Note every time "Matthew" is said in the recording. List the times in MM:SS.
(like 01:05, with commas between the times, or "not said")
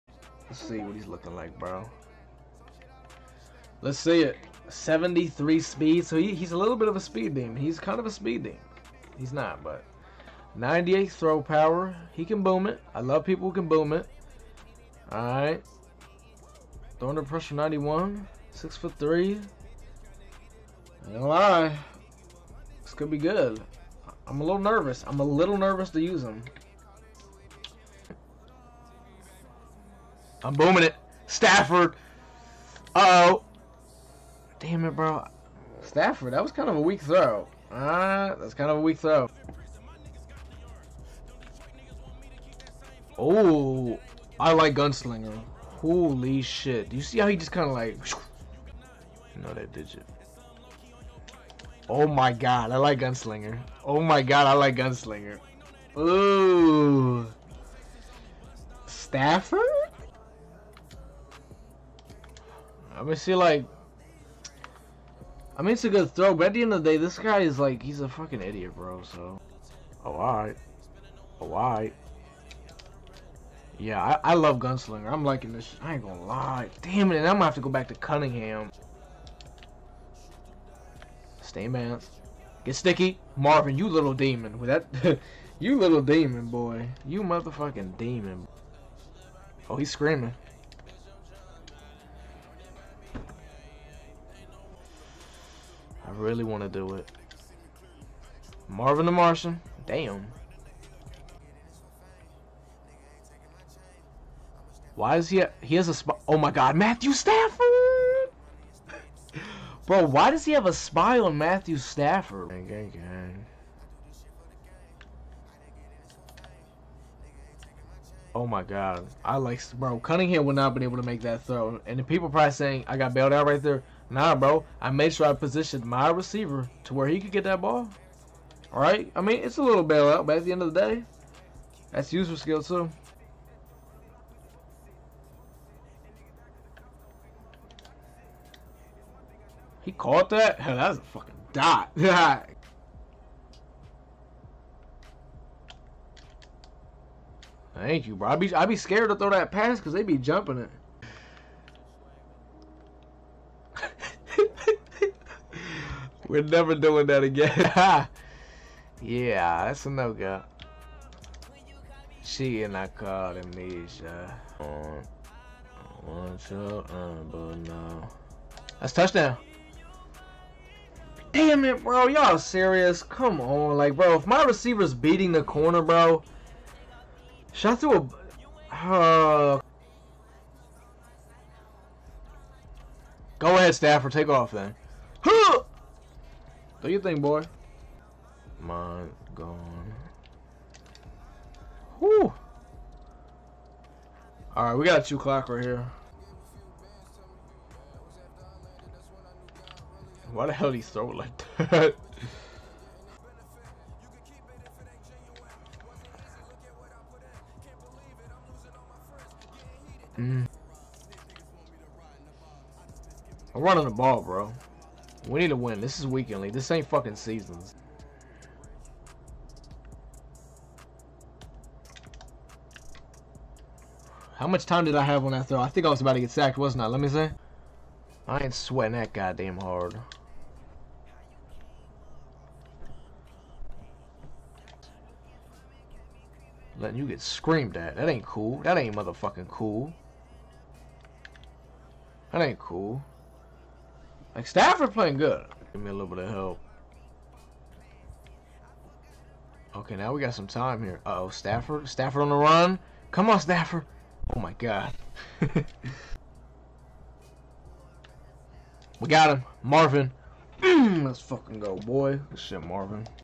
01:46, 01:51.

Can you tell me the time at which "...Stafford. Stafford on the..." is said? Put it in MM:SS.
04:11.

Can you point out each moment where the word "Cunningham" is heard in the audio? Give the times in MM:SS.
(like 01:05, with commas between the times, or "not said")
01:17, 01:59.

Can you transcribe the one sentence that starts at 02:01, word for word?
And the people probably saying, I got bailed out right there.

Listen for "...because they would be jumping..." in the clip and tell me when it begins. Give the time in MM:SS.
02:29.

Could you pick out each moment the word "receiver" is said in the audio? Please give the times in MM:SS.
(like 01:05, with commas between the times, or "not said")
02:06, 02:54.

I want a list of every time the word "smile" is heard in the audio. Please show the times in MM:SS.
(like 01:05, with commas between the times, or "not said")
01:45, 01:50.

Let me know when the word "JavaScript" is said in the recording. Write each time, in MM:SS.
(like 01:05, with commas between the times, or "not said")
not said.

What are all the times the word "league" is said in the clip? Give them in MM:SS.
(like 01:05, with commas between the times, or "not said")
03:36.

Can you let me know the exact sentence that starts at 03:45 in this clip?
I think I was about to get sacked, wasn't I?